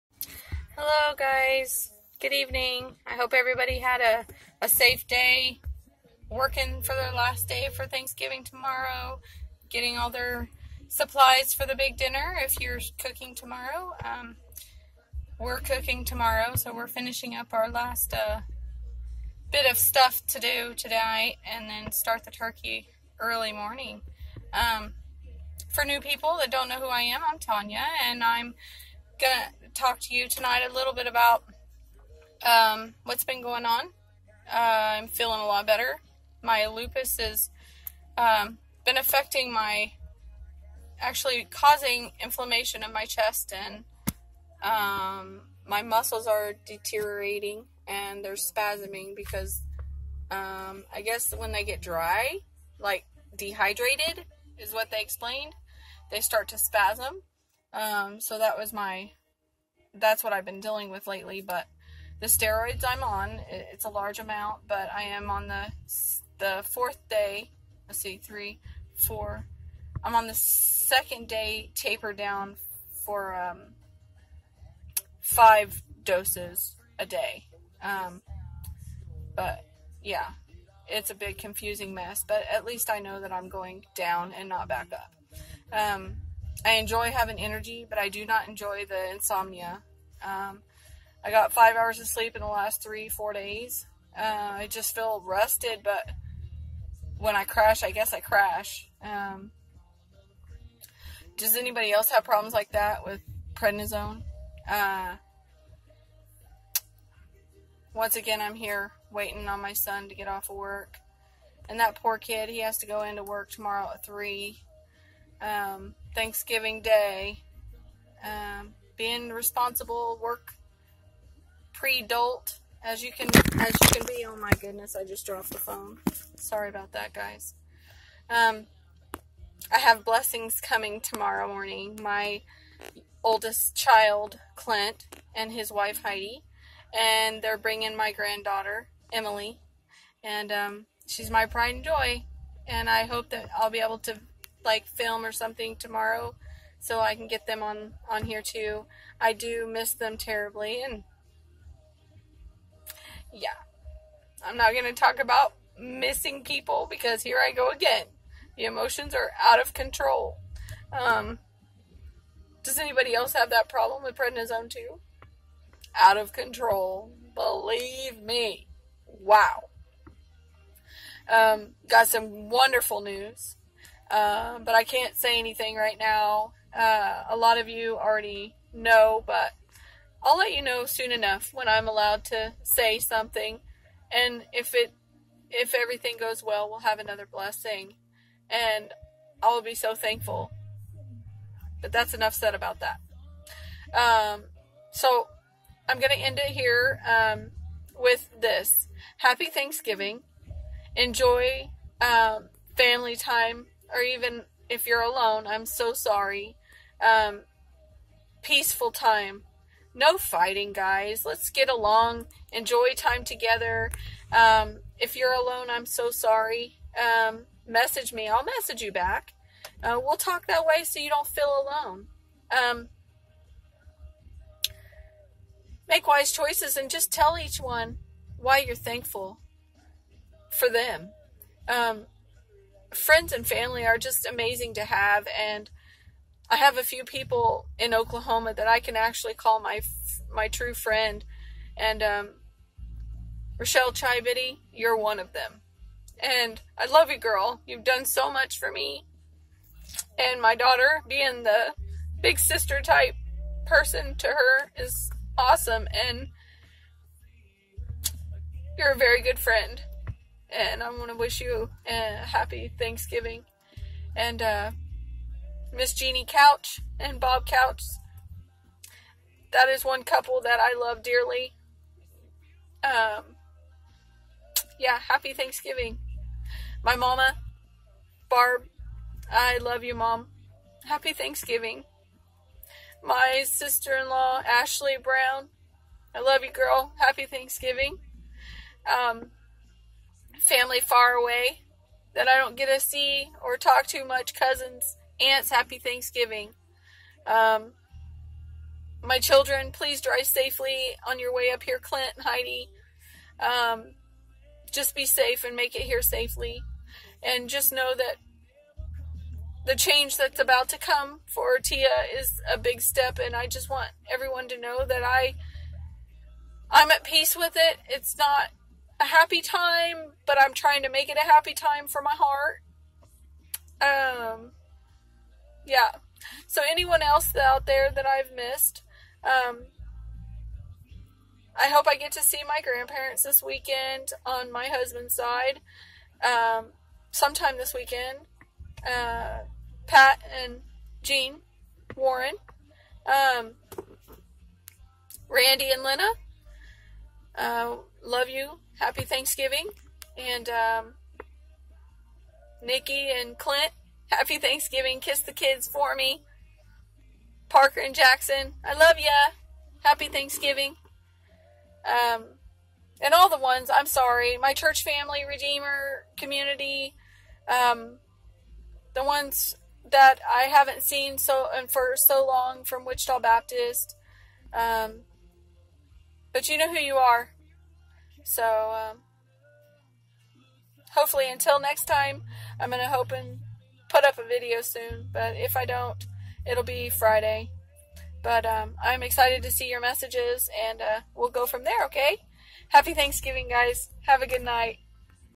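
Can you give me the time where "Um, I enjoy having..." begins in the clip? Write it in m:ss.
1:25.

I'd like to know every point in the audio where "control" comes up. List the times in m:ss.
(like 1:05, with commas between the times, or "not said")
2:39, 2:46.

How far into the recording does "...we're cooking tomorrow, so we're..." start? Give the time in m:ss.
0:15.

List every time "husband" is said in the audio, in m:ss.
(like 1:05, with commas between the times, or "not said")
5:34.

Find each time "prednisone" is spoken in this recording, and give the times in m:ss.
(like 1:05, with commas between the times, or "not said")
1:43, 2:44.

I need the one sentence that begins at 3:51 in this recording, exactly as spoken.
Um, friends and family are just amazing to have.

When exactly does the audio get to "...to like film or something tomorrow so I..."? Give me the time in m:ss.
2:23.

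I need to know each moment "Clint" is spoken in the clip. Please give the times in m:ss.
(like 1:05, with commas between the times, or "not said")
2:14, 5:01, 5:53.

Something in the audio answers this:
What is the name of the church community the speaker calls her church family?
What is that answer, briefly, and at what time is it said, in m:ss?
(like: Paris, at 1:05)
Redeemer community, at 6:05.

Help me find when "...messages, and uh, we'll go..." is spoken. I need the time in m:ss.
6:29.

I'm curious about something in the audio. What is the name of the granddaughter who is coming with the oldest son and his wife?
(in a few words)
Emily.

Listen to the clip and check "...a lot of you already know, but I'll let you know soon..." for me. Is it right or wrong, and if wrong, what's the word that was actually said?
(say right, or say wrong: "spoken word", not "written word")
right.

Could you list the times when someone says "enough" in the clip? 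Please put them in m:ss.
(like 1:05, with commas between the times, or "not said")
3:01, 3:12.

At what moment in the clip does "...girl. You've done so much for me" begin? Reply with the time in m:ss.
4:07.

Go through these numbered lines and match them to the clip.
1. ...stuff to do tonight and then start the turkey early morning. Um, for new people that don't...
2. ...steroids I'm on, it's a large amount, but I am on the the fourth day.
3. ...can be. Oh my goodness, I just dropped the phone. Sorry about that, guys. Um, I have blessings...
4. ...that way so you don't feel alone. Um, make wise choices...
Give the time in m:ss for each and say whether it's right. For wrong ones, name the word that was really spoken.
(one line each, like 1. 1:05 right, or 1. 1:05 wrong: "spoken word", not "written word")
1. 0:19 right
2. 1:02 right
3. 2:03 right
4. 3:40 right.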